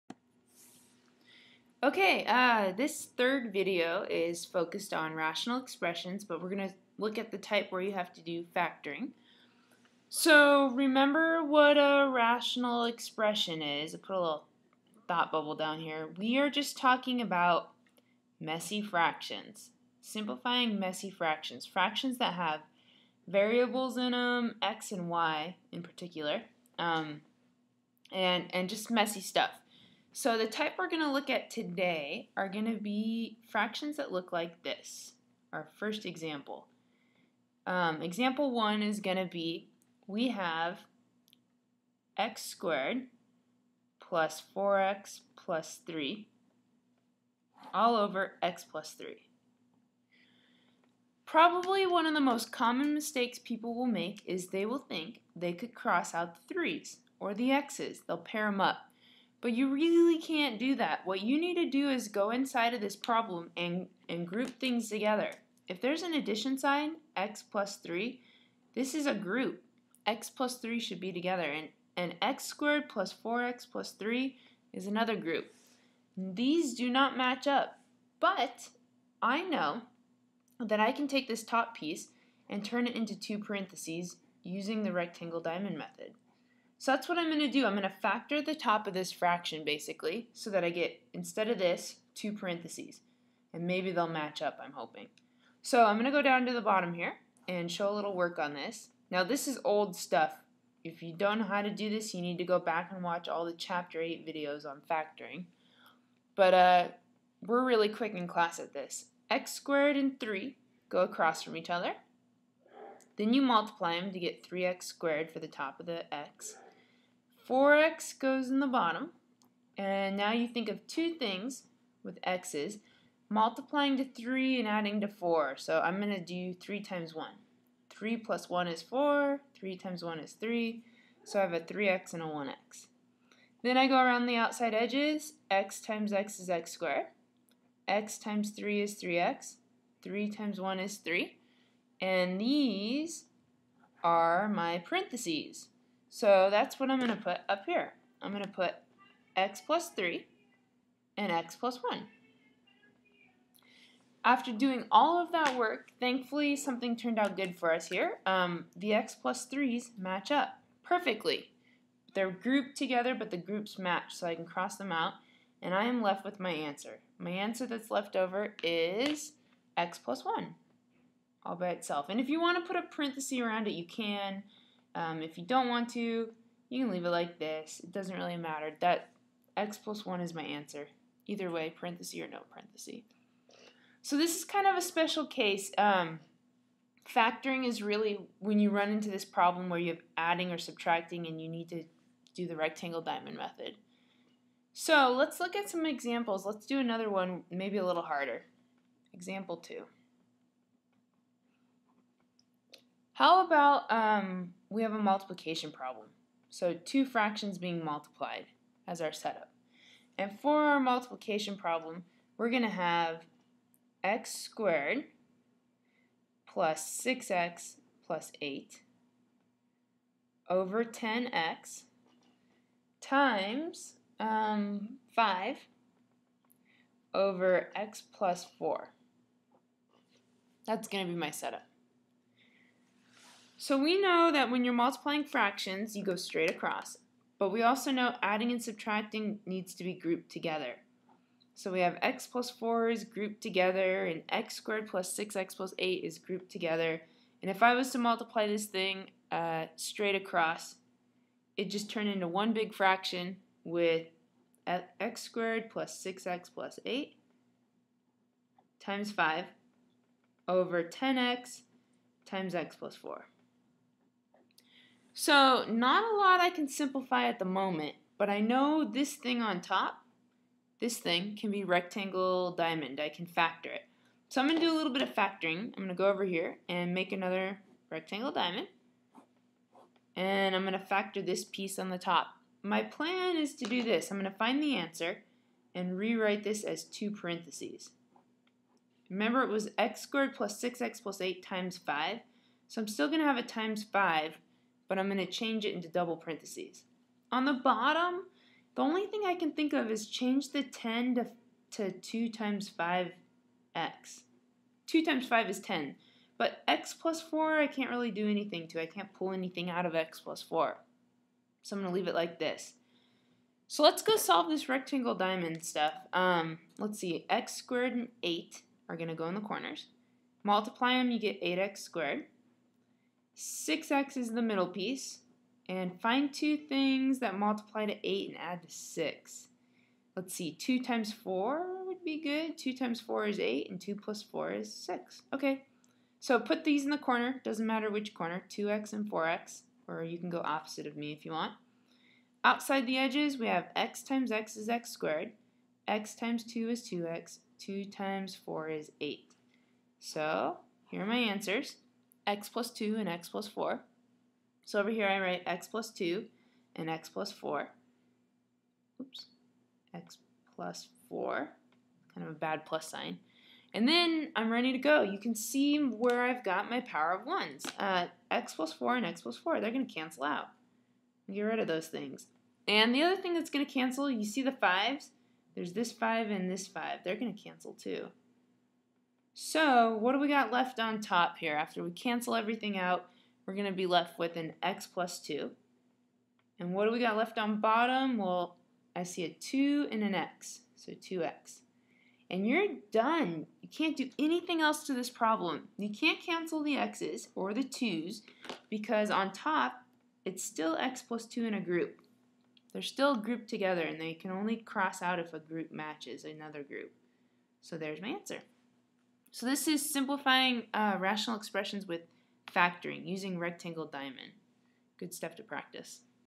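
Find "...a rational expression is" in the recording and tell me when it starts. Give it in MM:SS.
00:11.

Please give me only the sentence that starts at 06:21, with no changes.
After we cancel everything out, we're going to be left with an x plus 2.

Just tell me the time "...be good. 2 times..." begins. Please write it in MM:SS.
05:32.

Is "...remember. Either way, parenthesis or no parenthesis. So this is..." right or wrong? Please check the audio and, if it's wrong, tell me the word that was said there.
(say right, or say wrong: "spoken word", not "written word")
wrong: "answer", not "remember".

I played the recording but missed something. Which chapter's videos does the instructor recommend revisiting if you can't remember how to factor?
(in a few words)
Chapter 8.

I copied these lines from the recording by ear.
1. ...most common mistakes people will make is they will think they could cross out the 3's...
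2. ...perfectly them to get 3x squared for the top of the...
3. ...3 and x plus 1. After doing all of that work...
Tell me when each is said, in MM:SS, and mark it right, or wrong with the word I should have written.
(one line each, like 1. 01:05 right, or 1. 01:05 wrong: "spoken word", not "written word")
1. 00:52 right
2. 01:53 wrong: "multiply", not "perfectly"
3. 02:29 right.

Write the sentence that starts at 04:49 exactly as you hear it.
Remember it was x squared plus 6x plus 8 times 5.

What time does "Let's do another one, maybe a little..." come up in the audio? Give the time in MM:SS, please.
03:16.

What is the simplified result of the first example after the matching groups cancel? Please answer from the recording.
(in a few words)
x + 1.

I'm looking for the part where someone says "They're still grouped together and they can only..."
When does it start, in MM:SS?
06:42.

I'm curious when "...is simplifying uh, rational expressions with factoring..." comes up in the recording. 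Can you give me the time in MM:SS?
06:49.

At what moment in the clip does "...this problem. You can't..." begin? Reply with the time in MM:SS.
06:34.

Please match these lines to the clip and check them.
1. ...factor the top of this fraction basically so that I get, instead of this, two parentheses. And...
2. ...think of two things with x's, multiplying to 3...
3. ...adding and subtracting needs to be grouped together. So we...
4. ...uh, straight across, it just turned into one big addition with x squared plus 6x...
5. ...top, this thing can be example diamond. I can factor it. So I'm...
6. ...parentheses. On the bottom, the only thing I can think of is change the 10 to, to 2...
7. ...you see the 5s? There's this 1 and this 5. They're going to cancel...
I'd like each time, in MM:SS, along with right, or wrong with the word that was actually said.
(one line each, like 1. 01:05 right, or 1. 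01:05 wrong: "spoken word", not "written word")
1. 01:28 right
2. 02:00 right
3. 03:58 right
4. 04:09 wrong: "fraction", not "addition"
5. 04:29 wrong: "rectangle", not "example"
6. 04:56 right
7. 06:14 wrong: "5", not "1".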